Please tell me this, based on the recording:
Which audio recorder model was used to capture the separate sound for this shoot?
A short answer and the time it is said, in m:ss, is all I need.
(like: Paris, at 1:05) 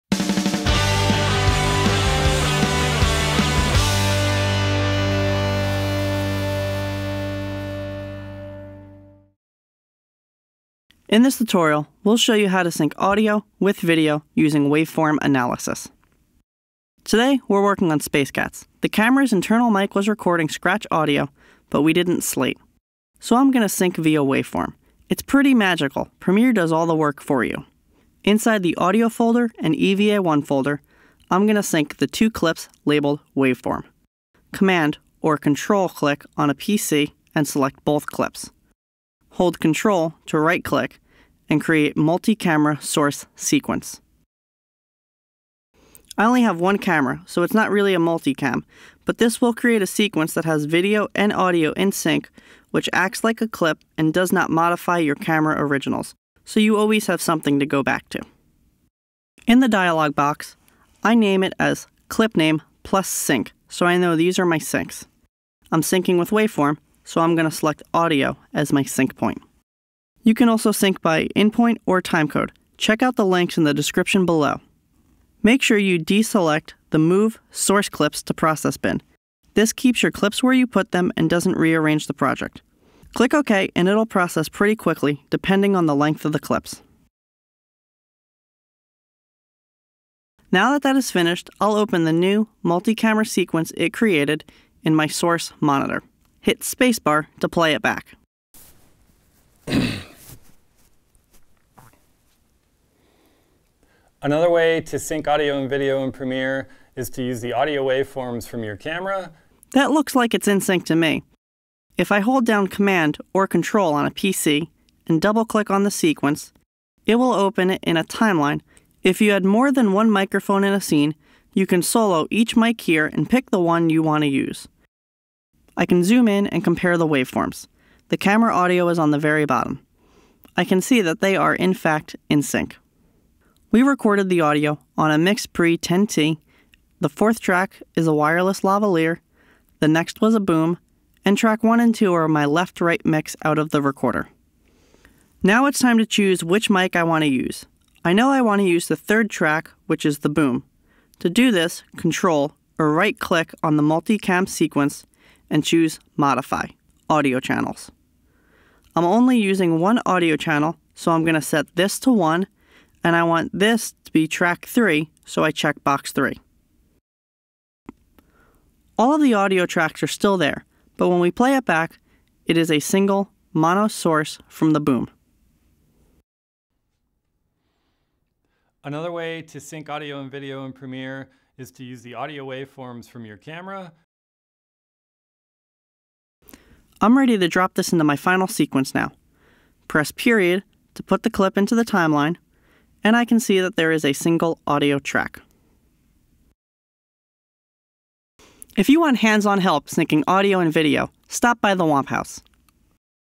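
Mix Pre 10T, at 2:15.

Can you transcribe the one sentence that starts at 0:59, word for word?
In the dialog box, I name it as clip name plus sync, so I know these are my syncs.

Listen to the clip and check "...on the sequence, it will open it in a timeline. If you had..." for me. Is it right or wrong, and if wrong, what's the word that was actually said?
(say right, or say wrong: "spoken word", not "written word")
right.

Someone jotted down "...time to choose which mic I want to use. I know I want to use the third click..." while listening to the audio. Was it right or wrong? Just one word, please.
wrong.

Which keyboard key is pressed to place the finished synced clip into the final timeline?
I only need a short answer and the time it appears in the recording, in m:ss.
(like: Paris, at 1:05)
period, at 3:10.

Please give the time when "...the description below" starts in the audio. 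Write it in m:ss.
1:13.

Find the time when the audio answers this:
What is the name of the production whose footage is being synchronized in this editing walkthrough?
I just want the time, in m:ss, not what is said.
0:17.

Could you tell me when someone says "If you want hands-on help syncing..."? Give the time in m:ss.
3:18.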